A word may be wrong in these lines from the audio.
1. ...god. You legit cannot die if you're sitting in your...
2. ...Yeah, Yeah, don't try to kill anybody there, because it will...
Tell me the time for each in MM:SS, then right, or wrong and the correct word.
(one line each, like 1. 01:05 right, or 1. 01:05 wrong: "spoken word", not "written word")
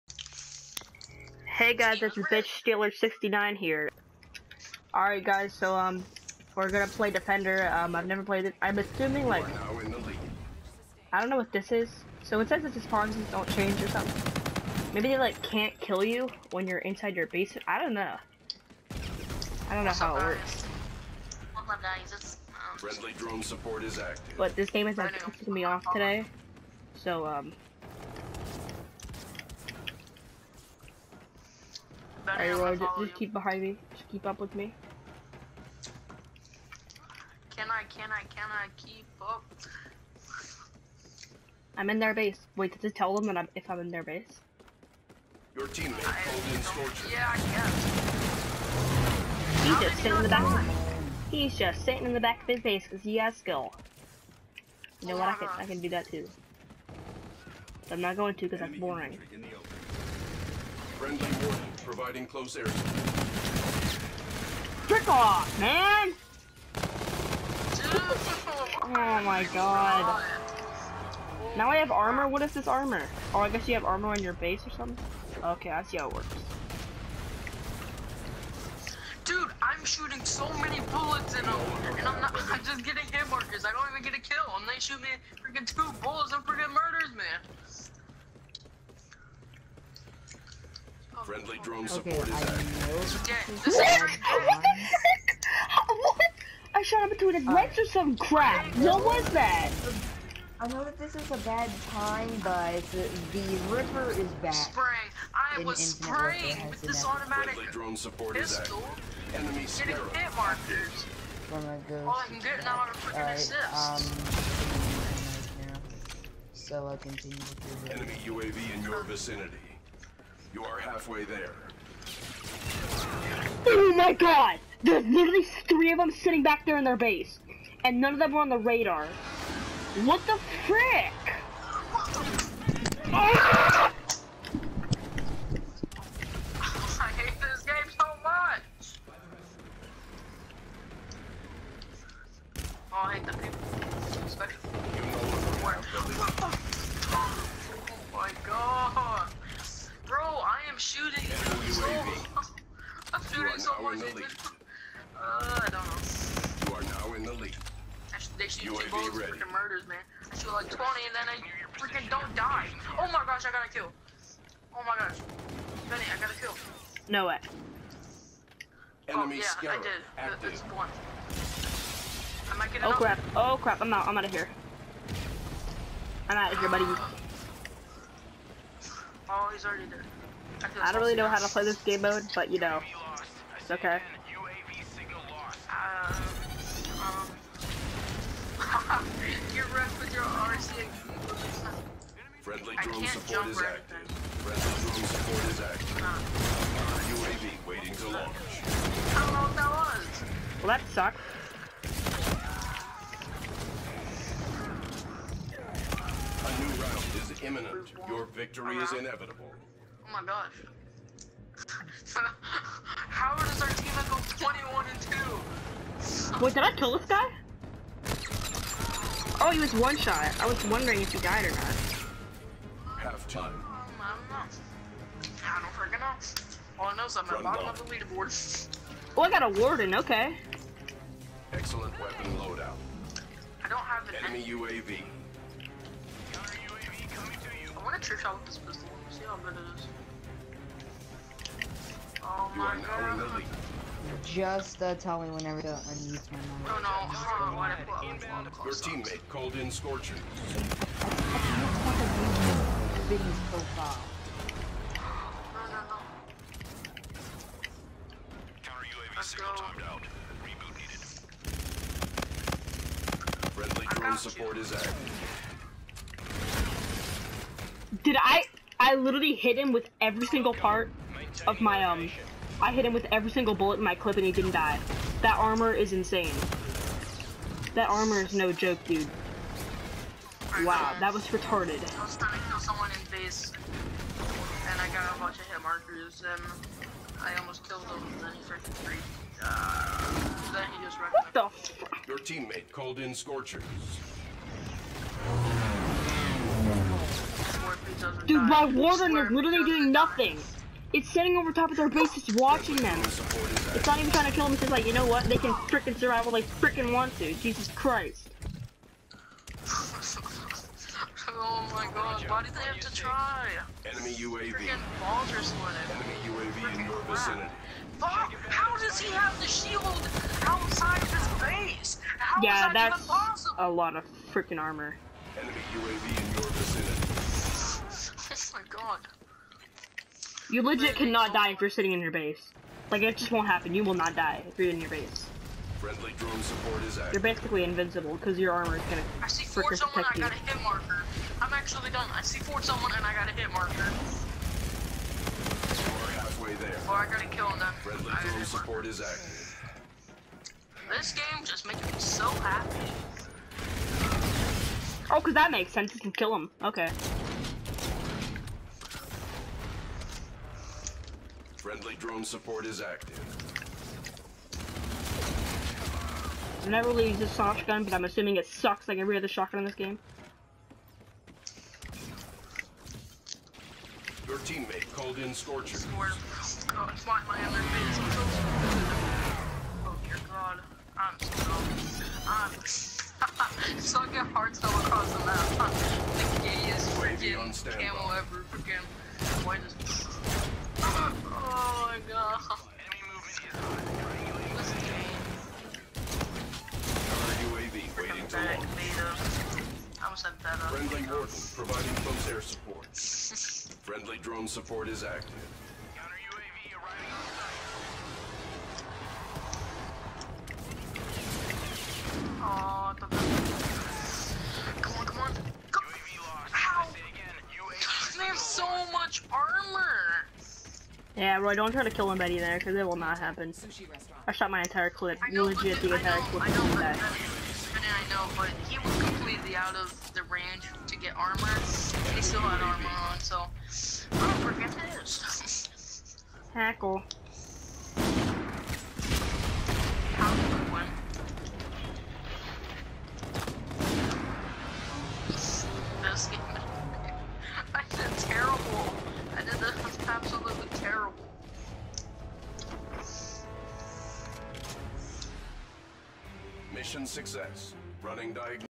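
1. 05:28 right
2. 07:01 wrong: "Roy", not "Yeah".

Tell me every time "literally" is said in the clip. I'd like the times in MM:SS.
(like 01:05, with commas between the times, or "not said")
02:05, 04:59.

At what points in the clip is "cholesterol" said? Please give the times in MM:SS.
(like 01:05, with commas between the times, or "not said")
not said.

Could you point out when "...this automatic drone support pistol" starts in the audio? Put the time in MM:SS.
01:46.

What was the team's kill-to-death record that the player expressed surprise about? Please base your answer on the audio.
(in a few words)
21 and 2.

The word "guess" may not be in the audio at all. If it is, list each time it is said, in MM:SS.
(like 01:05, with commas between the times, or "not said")
00:47, 01:13.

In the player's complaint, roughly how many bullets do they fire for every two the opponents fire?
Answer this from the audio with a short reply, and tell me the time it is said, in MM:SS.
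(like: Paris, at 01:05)
20, at 02:40.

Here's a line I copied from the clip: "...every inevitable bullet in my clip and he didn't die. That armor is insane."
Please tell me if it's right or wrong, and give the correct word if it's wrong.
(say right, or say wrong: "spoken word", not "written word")
wrong: "single", not "inevitable".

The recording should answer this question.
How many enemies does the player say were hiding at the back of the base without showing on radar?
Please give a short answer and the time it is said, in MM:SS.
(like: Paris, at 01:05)
3, at 02:05.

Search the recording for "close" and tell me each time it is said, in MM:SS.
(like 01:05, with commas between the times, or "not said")
01:02, 06:42.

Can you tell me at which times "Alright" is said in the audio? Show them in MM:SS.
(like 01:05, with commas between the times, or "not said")
00:04, 00:32.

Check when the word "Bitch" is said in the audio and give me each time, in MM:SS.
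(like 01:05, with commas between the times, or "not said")
00:02.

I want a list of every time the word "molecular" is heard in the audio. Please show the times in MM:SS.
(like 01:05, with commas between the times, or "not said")
not said.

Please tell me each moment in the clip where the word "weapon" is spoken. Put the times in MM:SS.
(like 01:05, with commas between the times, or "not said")
03:52.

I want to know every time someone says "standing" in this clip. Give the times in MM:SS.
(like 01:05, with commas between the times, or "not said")
05:01.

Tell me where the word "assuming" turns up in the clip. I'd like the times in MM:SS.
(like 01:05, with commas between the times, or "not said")
00:08, 06:08.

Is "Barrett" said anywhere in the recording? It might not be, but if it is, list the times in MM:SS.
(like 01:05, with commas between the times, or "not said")
not said.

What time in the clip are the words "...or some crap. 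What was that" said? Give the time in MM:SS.
01:37.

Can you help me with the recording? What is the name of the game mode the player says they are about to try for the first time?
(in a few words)
Defender.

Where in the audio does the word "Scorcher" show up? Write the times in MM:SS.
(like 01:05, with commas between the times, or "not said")
00:46, 04:53, 06:15.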